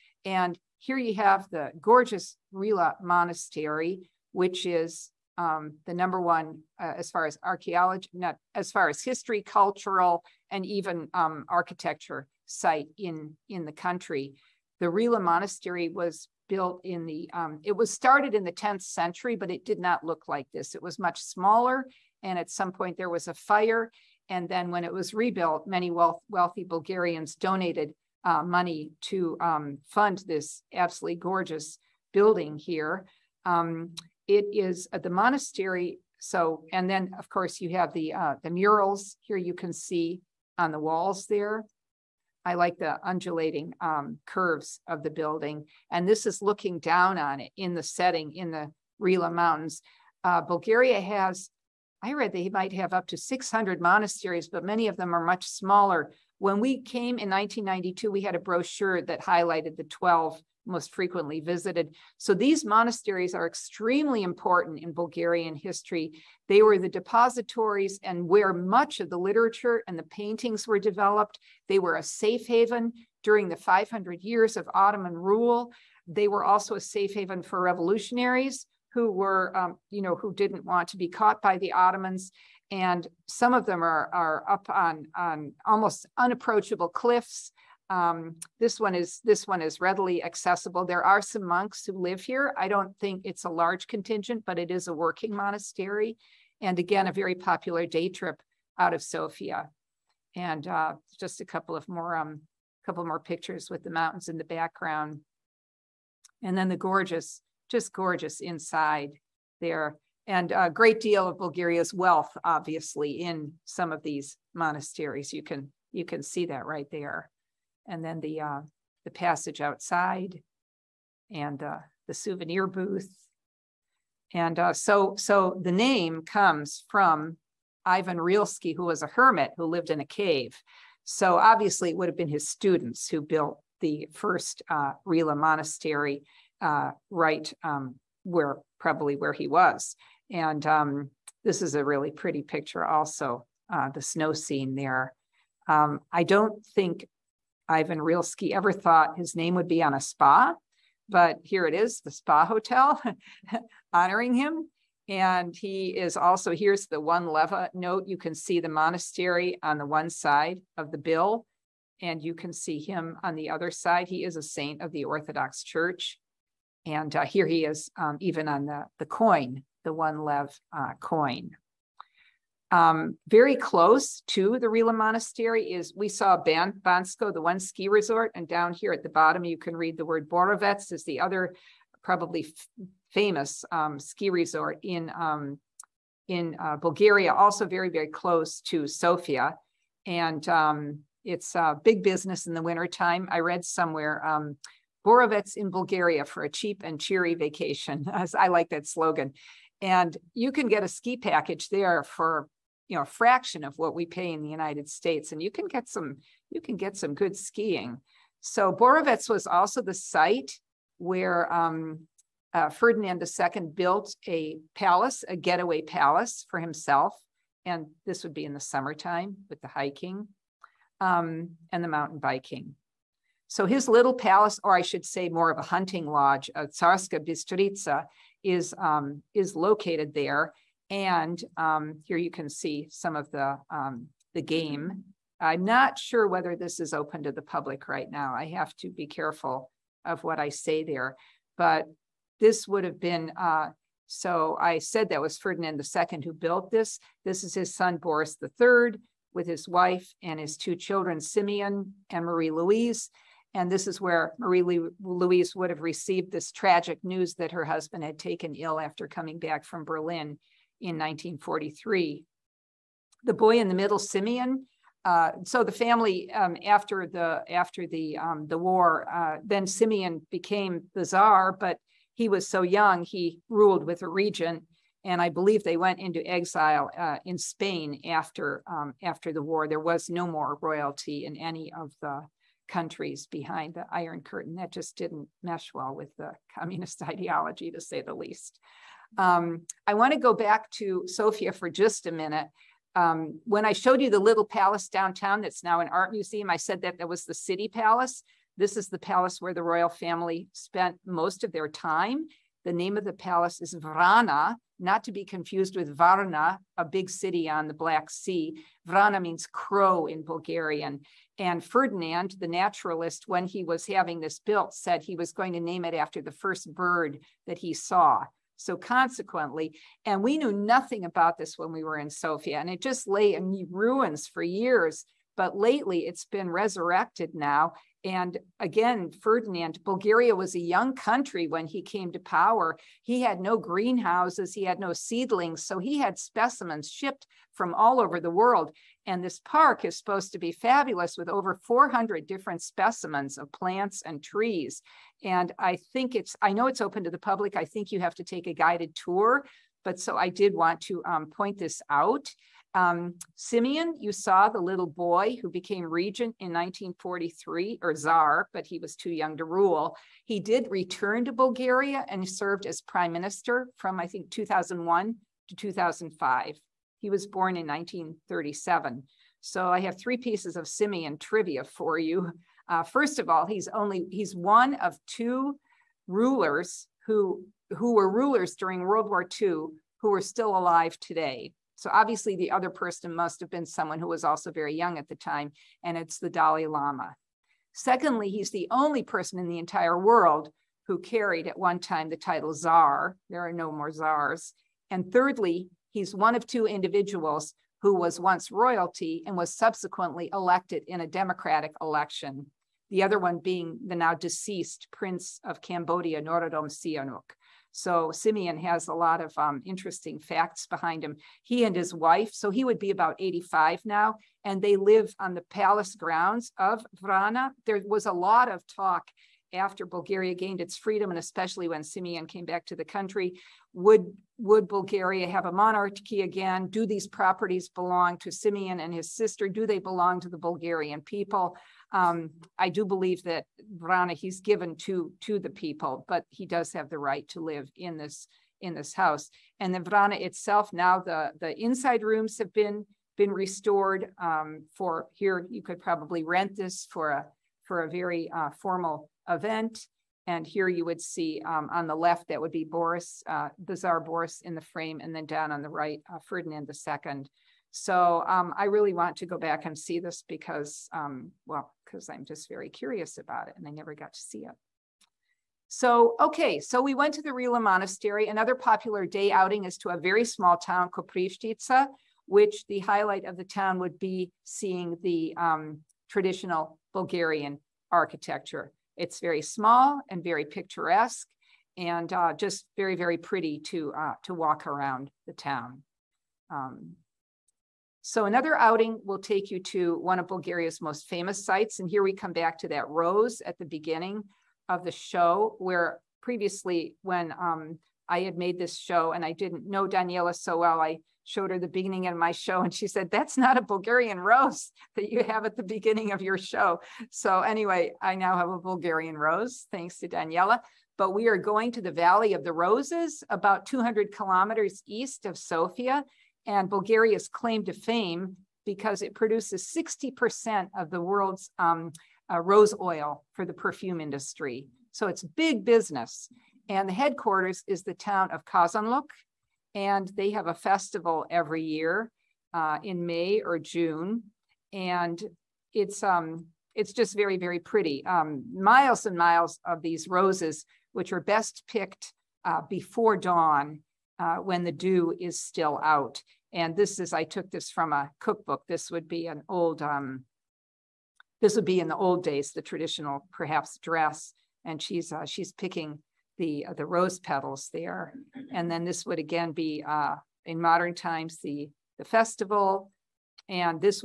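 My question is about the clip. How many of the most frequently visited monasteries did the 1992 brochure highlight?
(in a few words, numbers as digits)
12.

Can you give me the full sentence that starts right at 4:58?
This is the palace where the royal family spent most of their time.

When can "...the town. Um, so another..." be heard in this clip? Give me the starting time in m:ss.
8:05.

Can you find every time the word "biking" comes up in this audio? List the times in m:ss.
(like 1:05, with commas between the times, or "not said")
3:42.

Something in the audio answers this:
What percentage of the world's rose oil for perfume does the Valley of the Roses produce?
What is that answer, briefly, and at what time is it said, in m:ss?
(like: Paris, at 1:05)
60%, at 8:39.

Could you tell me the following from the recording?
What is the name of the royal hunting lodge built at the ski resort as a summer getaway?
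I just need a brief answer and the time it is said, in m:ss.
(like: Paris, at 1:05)
Tsarska Bistrica, at 3:46.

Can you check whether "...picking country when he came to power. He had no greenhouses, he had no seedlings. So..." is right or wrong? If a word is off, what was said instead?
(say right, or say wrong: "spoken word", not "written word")
wrong: "young", not "picking".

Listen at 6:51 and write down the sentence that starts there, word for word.
He and his wife, so he would be about 85 now, and they live on the palace grounds of Vrana.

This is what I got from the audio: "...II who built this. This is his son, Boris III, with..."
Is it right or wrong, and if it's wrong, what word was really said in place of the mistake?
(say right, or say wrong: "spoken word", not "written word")
right.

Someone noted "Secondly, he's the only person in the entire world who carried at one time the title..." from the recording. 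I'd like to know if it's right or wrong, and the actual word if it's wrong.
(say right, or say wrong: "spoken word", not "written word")
right.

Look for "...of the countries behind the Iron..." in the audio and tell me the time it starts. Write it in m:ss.
4:41.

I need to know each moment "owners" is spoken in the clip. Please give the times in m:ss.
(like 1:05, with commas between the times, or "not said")
not said.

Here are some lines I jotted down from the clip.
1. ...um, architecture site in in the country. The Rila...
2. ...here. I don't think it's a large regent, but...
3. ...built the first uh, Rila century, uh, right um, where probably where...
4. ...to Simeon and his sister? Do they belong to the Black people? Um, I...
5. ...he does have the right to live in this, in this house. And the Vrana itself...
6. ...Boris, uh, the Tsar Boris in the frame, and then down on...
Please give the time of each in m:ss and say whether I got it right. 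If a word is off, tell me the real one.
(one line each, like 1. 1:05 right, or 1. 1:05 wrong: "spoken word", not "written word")
1. 0:11 right
2. 1:32 wrong: "contingent", not "regent"
3. 2:13 wrong: "monastery", not "century"
4. 7:08 wrong: "Bulgarian", not "Black"
5. 7:16 right
6. 7:32 right.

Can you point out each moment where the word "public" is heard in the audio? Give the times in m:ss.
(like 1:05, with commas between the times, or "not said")
3:57, 5:47.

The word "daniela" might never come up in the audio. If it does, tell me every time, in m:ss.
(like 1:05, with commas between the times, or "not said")
8:19, 8:30.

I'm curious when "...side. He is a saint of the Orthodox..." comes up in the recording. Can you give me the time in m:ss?
2:43.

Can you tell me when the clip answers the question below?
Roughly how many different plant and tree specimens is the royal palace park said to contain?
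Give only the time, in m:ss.
5:41.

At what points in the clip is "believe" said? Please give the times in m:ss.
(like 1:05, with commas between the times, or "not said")
4:35, 7:12.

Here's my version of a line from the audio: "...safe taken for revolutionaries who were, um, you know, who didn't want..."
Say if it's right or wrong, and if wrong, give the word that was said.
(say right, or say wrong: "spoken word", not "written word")
wrong: "haven", not "taken".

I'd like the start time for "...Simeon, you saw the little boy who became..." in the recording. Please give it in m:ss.
5:53.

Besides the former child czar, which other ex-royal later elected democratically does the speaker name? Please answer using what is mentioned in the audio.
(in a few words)
Norodom Sihanouk.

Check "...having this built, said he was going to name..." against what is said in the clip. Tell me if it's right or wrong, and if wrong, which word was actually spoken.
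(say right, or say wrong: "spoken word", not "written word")
right.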